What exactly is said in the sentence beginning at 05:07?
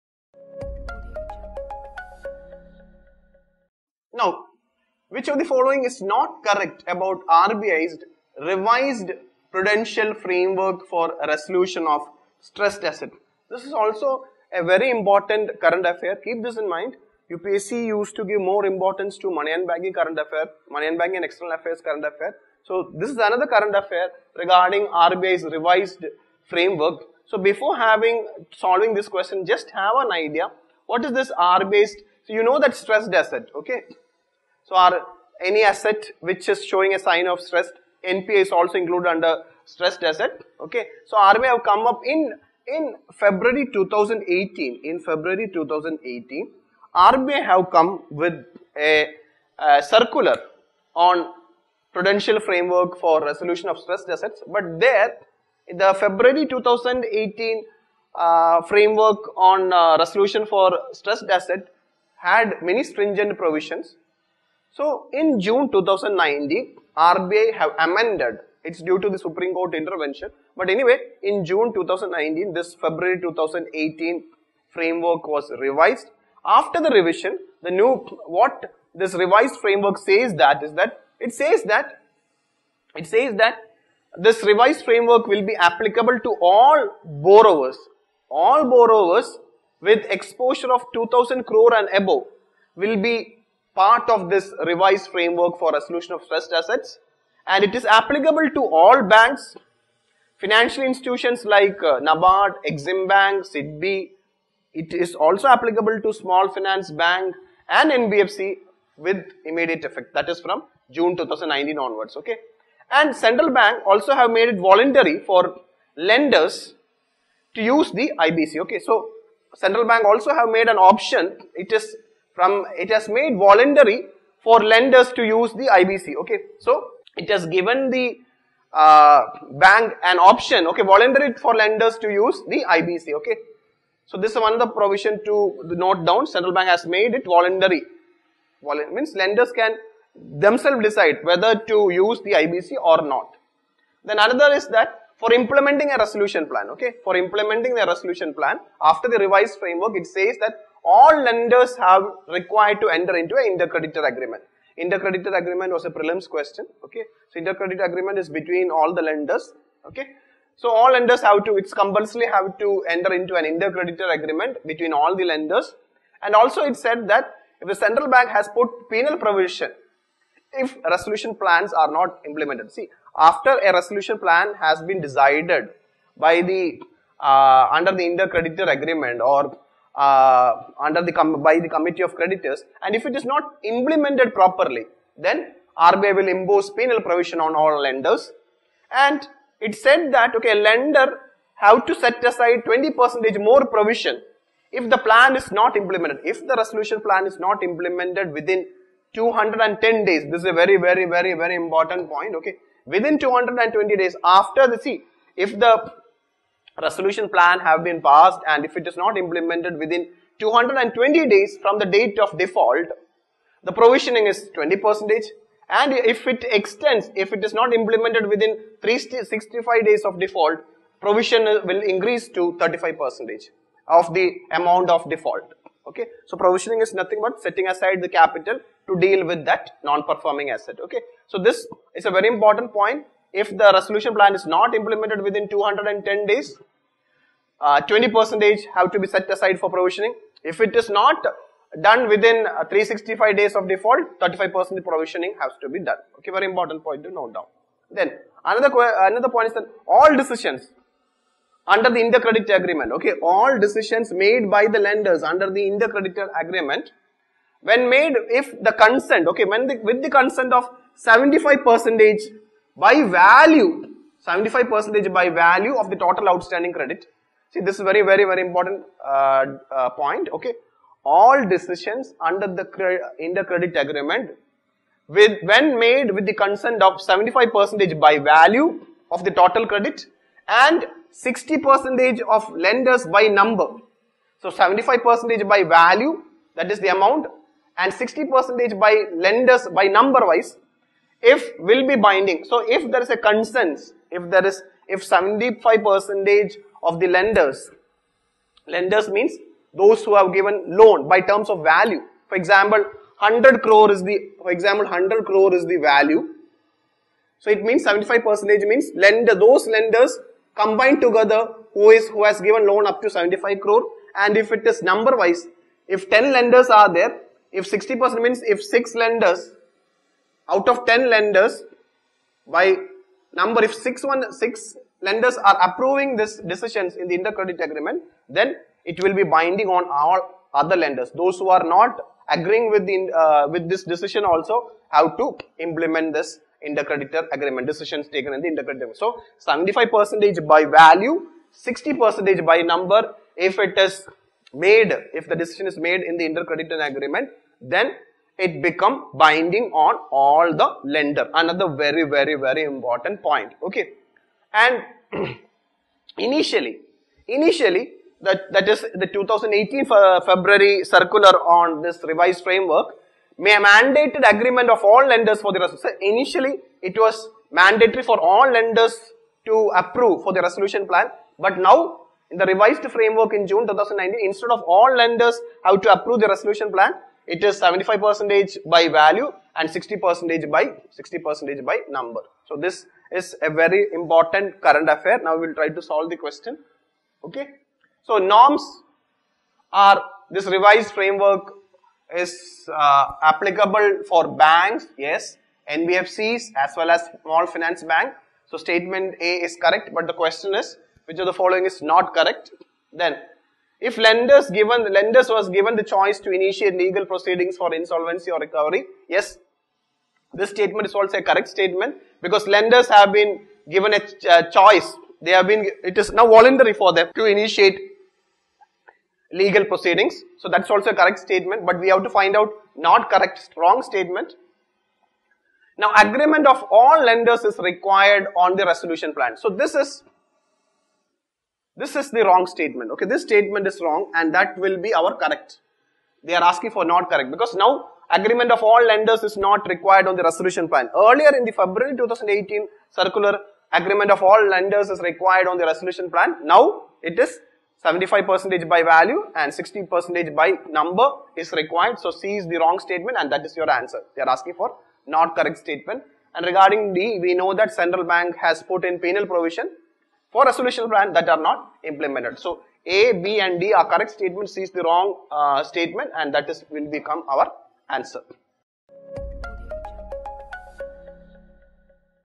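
So it means 75 percentage means lender, those lenders combined together who is, who has given loan up to 75 crore.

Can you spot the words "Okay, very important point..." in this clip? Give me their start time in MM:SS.
04:06.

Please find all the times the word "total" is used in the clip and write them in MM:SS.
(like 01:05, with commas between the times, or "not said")
04:25, 04:39.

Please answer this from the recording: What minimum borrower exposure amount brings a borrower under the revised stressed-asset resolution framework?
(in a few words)
2000 crore.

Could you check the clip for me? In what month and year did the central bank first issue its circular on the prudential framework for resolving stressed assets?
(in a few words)
February 2018.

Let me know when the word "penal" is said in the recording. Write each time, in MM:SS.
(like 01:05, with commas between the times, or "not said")
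02:48, 03:06, 07:38.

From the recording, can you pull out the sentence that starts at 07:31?
So C is the wrong statement and that is your answer.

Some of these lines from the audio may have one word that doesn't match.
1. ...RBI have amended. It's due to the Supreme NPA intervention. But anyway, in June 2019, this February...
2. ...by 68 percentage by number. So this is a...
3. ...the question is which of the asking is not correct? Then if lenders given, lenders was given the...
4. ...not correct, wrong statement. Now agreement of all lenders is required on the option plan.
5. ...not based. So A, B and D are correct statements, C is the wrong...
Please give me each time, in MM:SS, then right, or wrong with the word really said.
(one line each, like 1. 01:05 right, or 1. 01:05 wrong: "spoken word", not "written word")
1. 01:07 wrong: "Court", not "NPA"
2. 06:20 wrong: "60", not "68"
3. 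06:40 wrong: "following", not "asking"
4. 07:02 wrong: "resolution", not "option"
5. 07:41 wrong: "implemented", not "based".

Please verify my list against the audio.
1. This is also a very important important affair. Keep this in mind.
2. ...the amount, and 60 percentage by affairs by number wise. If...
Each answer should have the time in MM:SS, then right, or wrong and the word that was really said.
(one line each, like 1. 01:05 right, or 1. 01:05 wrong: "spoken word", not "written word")
1. 00:13 wrong: "current", not "important"
2. 04:46 wrong: "lenders", not "affairs".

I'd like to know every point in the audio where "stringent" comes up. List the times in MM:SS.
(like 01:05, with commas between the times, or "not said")
01:02.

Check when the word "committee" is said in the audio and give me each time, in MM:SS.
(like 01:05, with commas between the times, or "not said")
03:01.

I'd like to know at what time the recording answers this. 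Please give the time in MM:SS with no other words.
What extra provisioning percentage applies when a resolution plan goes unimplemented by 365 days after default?
03:42.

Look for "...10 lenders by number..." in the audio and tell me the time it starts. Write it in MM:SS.
05:20.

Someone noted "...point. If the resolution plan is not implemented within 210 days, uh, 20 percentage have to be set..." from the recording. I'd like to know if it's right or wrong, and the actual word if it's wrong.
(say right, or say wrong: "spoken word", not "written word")
right.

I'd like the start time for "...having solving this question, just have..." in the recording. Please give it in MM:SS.
00:27.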